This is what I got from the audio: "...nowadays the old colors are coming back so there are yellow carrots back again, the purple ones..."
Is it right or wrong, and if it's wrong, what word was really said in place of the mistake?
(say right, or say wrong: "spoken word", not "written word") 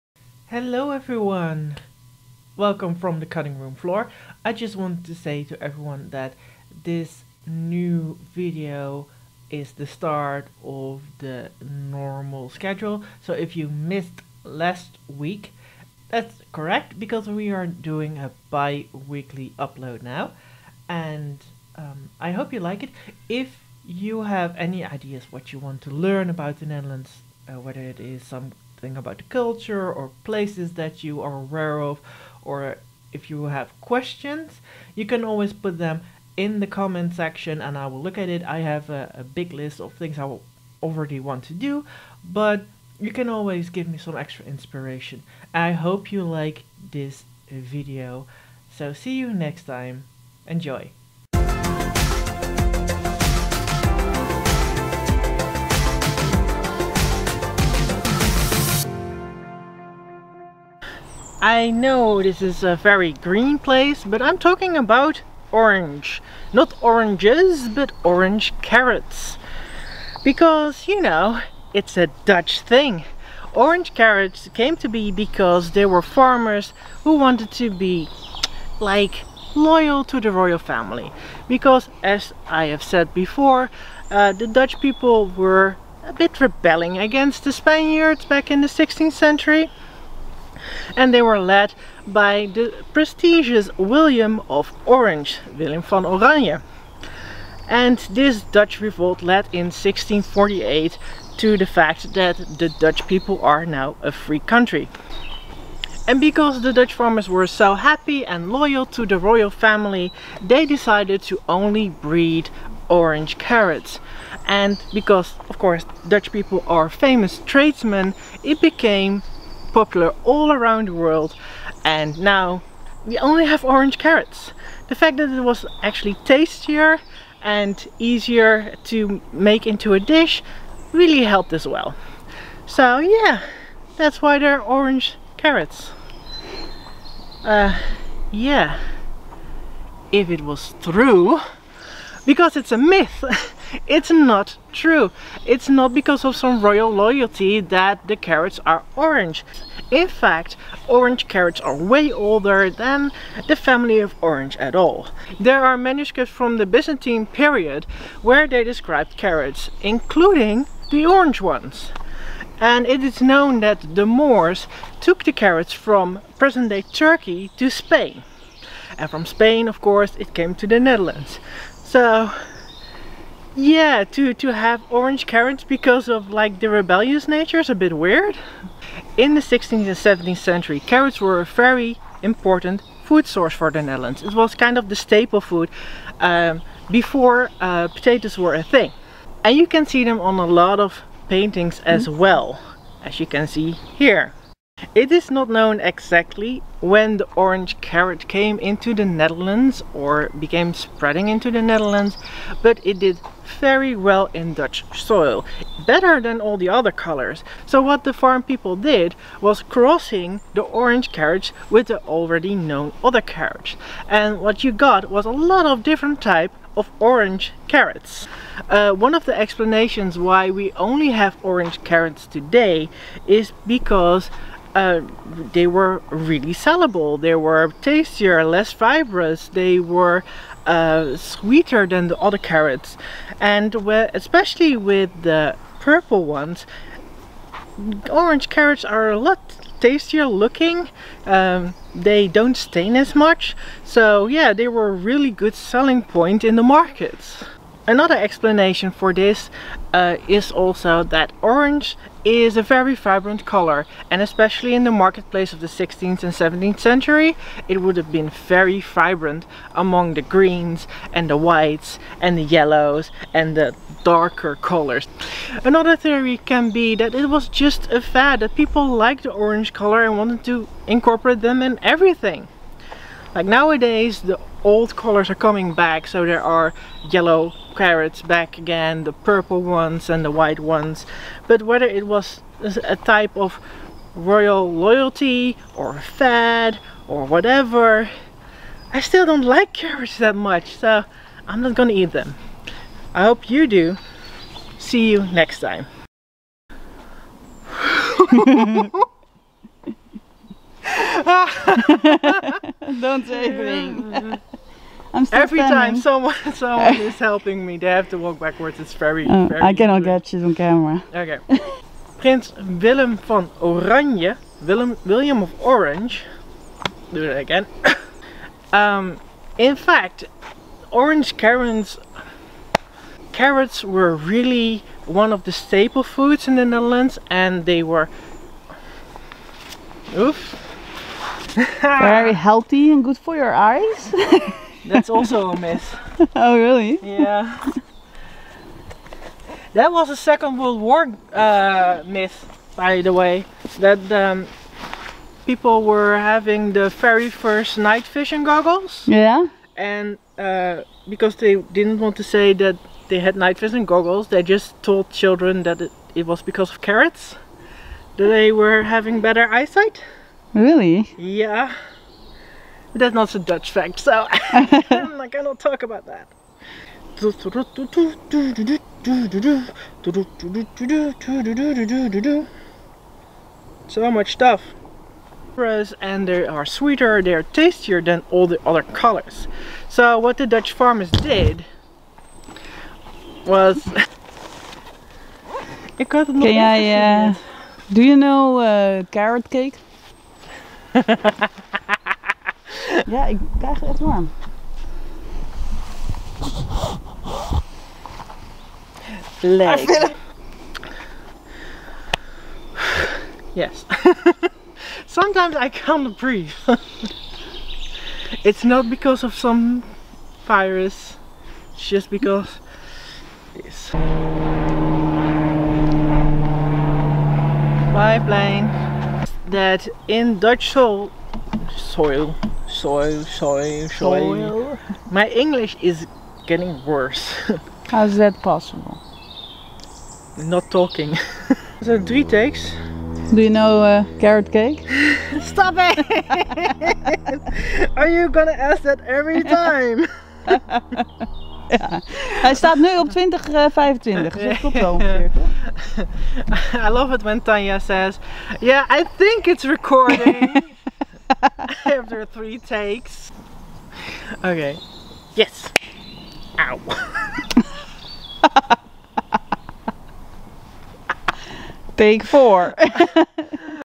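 right.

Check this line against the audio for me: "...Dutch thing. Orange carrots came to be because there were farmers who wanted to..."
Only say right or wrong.
right.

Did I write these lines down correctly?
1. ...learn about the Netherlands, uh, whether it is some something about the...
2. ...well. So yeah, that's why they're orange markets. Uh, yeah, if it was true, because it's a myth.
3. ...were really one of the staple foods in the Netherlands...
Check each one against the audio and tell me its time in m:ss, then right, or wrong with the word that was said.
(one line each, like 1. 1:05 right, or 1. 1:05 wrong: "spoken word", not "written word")
1. 0:25 right
2. 2:11 wrong: "carrots", not "markets"
3. 5:23 right.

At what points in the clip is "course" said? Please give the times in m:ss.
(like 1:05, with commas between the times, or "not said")
1:55, 2:49.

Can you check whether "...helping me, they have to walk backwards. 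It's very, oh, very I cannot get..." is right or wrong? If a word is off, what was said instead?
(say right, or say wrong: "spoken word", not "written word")
right.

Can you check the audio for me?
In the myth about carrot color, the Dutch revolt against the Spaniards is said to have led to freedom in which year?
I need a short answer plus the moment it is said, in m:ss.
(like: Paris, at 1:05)
1648, at 1:39.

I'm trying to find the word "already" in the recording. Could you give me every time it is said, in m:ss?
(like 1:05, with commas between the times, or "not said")
0:40, 3:32.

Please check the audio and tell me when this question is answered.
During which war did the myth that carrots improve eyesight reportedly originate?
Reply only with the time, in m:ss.
5:40.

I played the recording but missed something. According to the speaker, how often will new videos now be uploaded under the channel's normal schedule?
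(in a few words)
Bi-weekly.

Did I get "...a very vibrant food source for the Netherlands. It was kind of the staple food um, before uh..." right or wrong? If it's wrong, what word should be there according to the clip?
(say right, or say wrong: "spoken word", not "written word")
wrong: "important", not "vibrant".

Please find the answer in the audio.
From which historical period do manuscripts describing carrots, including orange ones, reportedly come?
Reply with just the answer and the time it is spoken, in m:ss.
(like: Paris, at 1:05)
Byzantine period, at 2:36.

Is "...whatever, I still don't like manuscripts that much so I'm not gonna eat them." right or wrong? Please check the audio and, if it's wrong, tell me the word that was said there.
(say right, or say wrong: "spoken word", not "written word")
wrong: "carrots", not "manuscripts".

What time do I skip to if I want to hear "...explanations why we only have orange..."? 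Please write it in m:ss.
3:39.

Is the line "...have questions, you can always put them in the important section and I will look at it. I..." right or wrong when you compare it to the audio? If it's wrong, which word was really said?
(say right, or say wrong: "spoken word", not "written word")
wrong: "comment", not "important".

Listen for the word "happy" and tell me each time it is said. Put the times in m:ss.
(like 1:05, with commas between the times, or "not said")
1:47.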